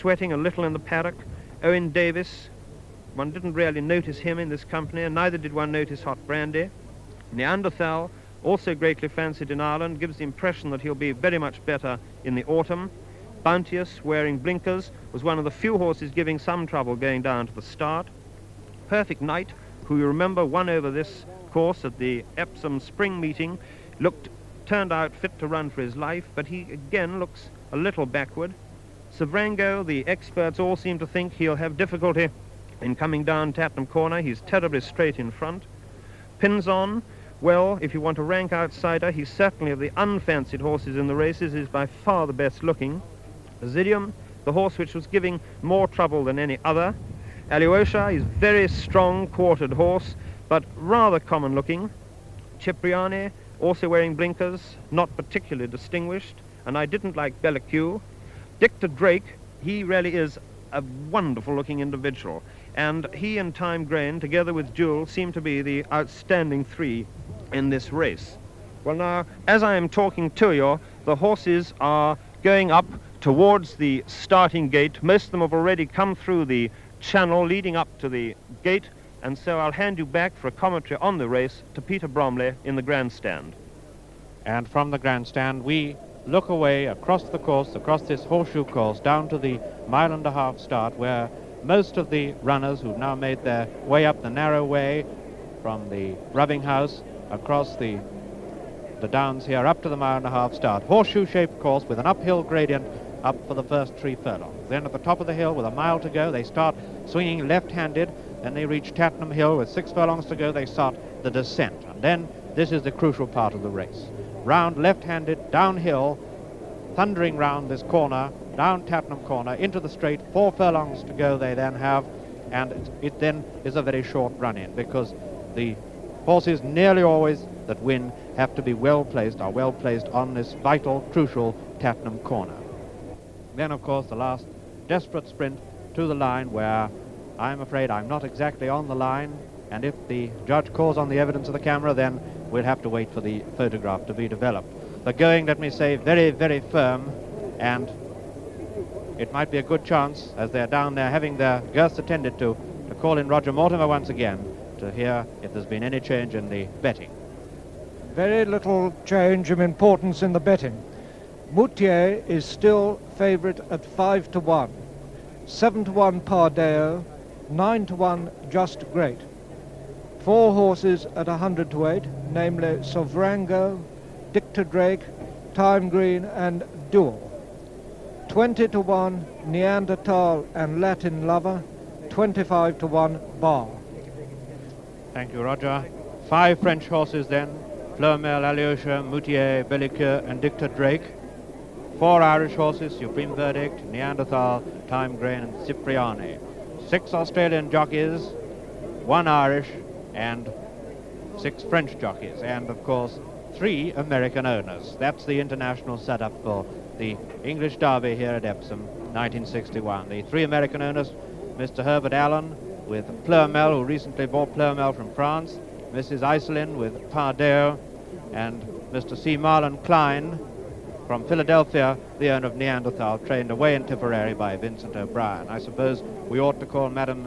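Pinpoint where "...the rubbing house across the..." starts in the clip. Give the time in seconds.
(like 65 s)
95 s.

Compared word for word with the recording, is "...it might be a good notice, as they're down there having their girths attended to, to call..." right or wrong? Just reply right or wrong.
wrong.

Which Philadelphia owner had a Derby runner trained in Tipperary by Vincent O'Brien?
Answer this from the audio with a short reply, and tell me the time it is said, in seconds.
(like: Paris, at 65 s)
C. Mahlon Kline, at 219 s.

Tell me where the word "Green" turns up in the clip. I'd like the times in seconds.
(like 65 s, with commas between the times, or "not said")
175 s, 195 s.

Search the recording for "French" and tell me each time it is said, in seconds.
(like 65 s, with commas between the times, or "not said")
186 s, 201 s.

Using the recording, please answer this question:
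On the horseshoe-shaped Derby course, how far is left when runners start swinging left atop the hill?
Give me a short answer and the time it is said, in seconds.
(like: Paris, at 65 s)
a mile, at 105 s.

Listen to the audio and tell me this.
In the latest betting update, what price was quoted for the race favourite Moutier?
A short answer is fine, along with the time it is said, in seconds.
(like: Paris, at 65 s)
5 to 1, at 163 s.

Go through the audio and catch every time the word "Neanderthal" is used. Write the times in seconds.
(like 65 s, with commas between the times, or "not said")
7 s, 179 s, 193 s, 222 s.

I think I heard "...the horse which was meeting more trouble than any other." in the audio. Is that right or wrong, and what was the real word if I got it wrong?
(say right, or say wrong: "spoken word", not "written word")
wrong: "giving", not "meeting".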